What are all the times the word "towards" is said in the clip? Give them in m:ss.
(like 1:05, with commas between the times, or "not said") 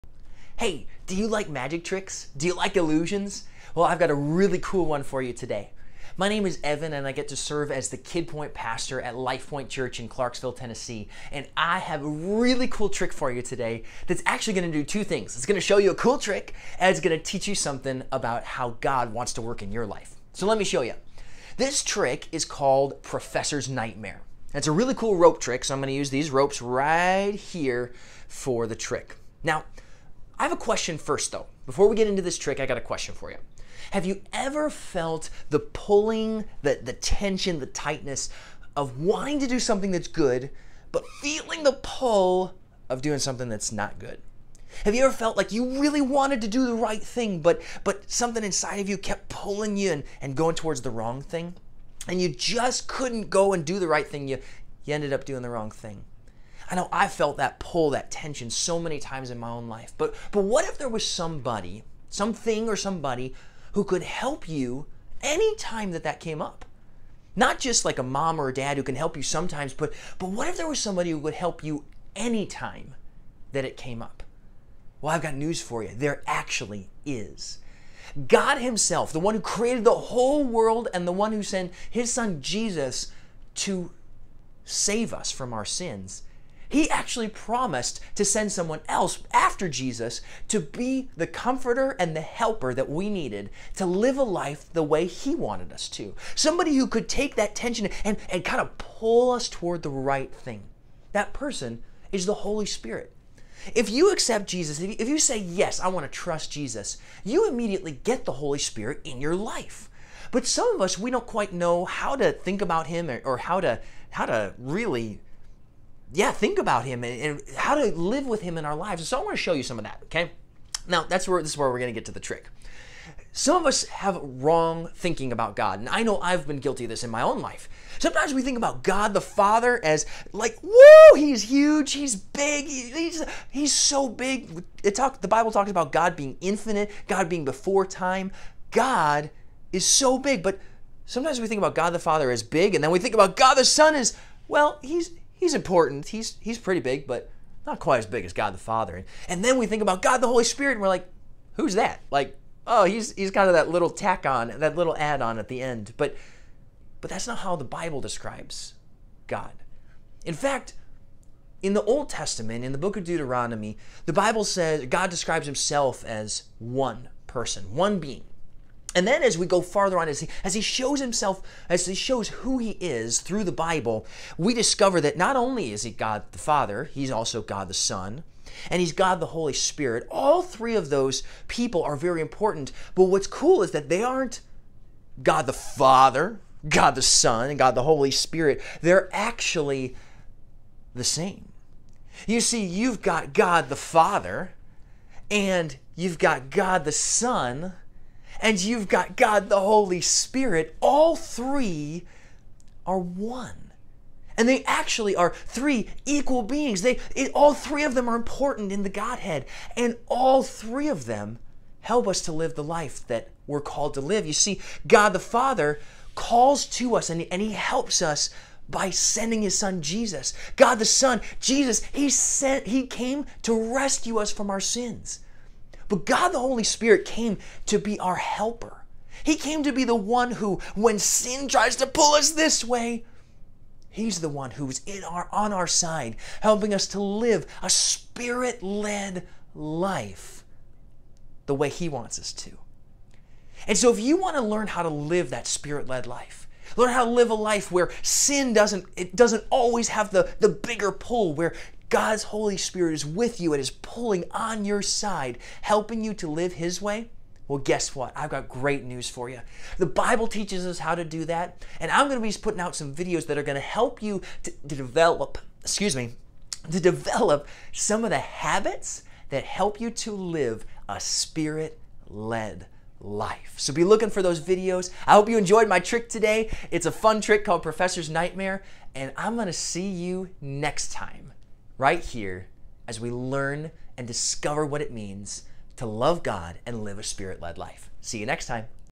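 0:50, 1:39.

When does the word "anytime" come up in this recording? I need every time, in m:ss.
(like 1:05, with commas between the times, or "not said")
1:05, 1:12.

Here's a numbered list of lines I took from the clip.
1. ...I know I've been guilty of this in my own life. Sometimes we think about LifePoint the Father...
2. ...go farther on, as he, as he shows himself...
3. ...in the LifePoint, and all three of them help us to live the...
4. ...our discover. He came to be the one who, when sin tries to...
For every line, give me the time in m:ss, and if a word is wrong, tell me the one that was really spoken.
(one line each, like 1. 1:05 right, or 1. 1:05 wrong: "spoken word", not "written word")
1. 2:05 wrong: "God", not "LifePoint"
2. 2:49 right
3. 3:28 wrong: "Godhead", not "LifePoint"
4. 3:47 wrong: "helper", not "discover".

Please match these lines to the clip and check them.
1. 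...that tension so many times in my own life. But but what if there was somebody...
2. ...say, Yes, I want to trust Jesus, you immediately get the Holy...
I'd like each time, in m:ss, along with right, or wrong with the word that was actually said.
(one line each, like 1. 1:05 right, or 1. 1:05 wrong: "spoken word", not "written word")
1. 0:57 right
2. 1:45 right.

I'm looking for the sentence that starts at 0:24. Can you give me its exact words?
It's a really cool rope trick, so I'm going to use these ropes right here for the trick.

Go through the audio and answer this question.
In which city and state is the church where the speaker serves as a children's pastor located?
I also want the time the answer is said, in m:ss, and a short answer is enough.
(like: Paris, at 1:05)
Clarksville, Tennessee, at 0:10.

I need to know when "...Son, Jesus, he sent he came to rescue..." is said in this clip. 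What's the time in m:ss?
3:40.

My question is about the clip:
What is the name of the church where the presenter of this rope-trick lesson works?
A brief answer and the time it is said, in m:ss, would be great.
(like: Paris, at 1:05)
LifePoint Church, at 0:09.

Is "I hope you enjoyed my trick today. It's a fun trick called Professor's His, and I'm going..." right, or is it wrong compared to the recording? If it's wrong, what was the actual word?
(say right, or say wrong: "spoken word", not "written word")
wrong: "Nightmare", not "His".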